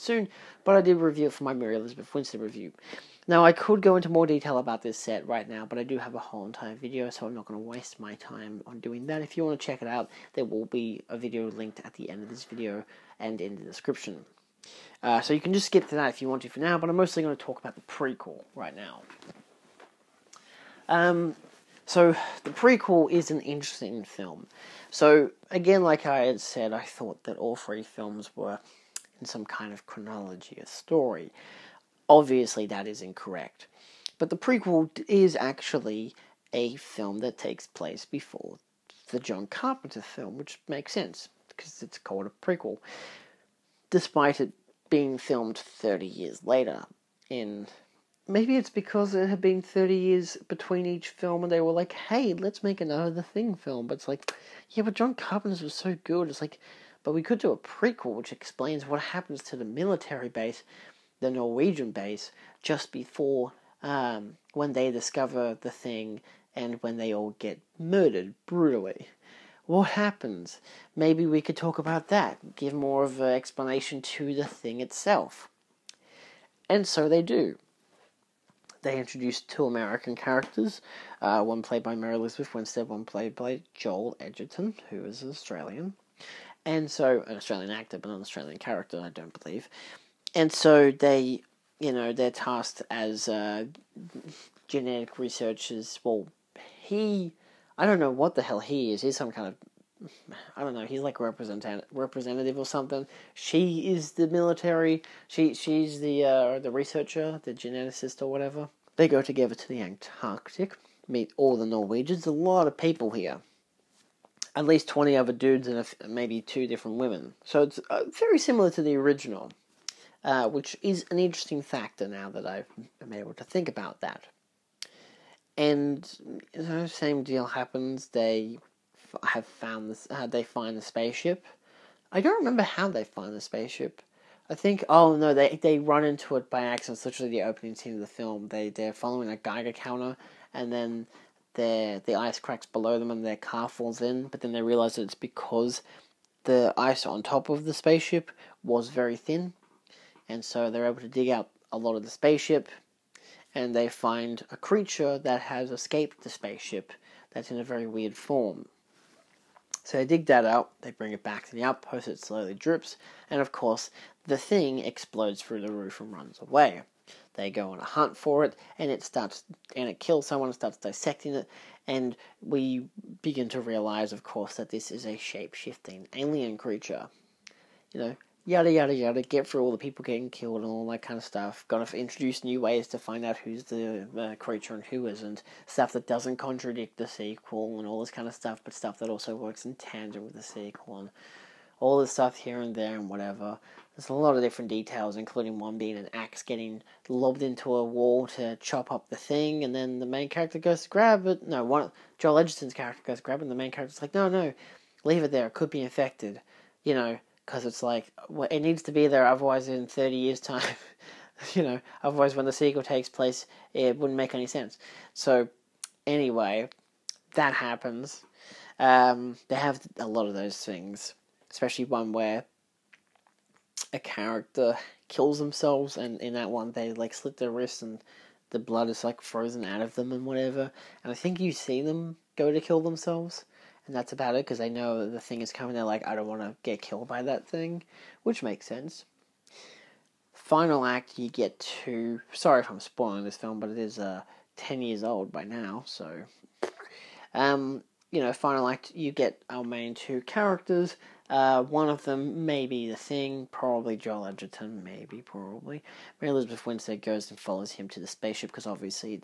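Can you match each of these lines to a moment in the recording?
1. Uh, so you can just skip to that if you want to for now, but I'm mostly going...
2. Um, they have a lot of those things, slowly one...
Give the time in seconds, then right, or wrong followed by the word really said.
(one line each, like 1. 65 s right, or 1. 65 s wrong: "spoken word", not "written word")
1. 15 s right
2. 218 s wrong: "especially", not "slowly".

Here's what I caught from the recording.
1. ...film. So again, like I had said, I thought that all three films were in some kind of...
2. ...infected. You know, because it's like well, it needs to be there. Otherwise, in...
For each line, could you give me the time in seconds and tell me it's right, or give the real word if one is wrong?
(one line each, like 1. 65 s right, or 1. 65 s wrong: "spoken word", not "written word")
1. 24 s right
2. 205 s right.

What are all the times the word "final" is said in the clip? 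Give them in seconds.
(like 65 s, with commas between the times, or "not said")
240 s, 248 s.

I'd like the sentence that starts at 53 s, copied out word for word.
But it's like, yeah, but John Carpenter's was so good.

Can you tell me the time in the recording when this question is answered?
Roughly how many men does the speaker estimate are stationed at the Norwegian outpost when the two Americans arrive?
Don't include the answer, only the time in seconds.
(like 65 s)
114 s.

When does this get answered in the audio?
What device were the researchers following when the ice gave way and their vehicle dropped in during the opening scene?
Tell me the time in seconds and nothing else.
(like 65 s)
139 s.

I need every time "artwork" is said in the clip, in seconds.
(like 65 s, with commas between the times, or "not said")
not said.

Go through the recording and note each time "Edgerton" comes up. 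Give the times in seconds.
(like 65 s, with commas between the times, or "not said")
84 s, 202 s, 254 s.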